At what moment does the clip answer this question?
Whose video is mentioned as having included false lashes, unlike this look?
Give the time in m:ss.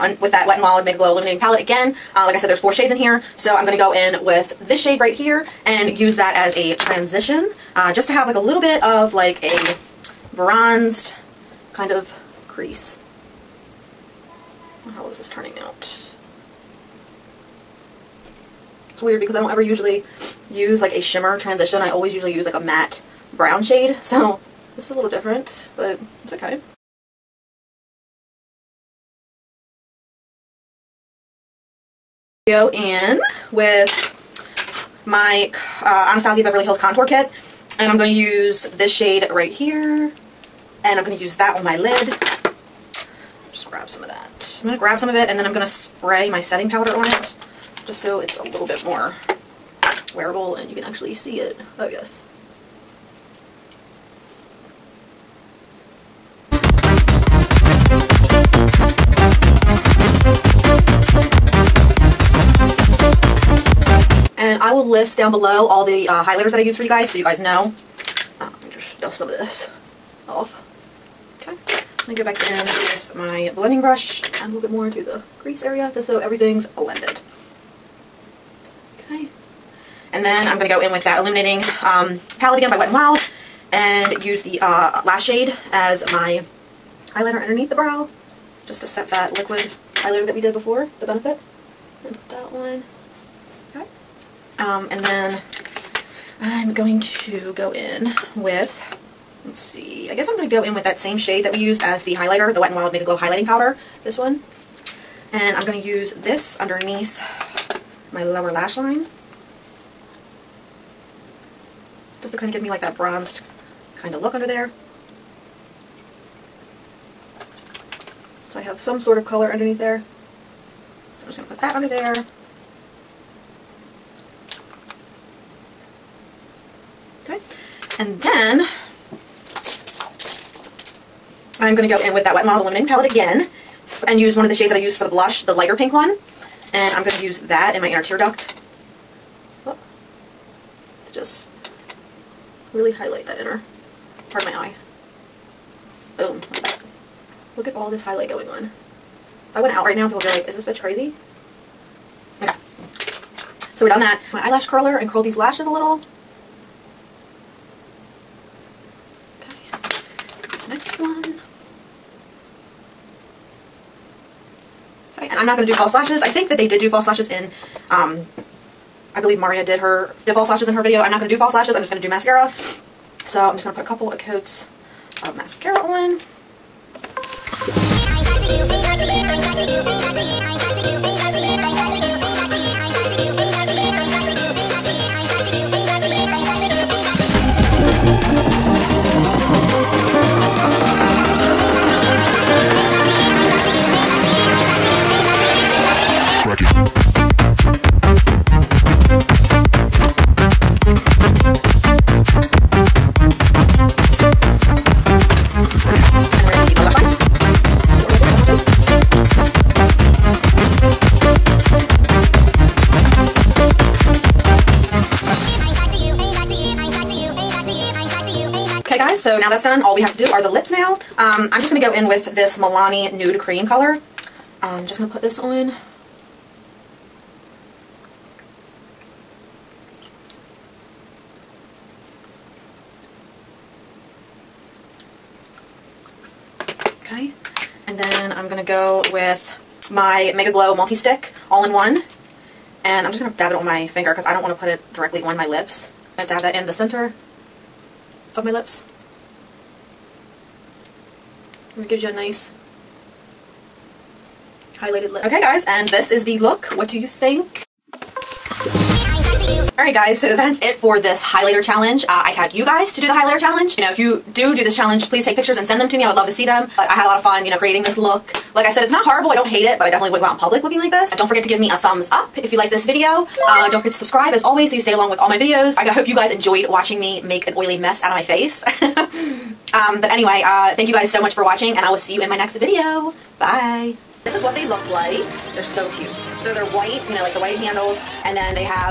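2:49.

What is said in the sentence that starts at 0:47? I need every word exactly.
Just so it's a little bit more wearable and you can actually see it.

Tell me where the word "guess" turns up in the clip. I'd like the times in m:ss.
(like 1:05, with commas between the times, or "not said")
1:40.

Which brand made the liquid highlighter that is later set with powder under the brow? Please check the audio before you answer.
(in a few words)
Benefit.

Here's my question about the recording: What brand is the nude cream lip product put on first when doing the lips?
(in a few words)
Milani.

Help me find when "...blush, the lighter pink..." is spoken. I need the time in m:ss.
2:15.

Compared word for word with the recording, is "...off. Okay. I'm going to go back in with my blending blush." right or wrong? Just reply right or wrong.
wrong.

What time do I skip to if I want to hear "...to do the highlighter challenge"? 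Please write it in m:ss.
4:22.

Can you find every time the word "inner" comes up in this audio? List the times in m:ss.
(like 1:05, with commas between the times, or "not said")
2:17, 2:23.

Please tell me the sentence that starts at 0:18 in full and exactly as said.
It's weird because I don't ever usually use like a shimmer transition.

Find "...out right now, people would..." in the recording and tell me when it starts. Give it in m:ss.
2:29.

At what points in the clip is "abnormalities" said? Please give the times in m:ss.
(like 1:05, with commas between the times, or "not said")
not said.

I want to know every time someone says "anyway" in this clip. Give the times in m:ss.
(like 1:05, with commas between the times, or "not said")
4:40.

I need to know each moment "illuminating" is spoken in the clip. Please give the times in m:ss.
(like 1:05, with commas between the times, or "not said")
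0:01, 1:21, 2:12.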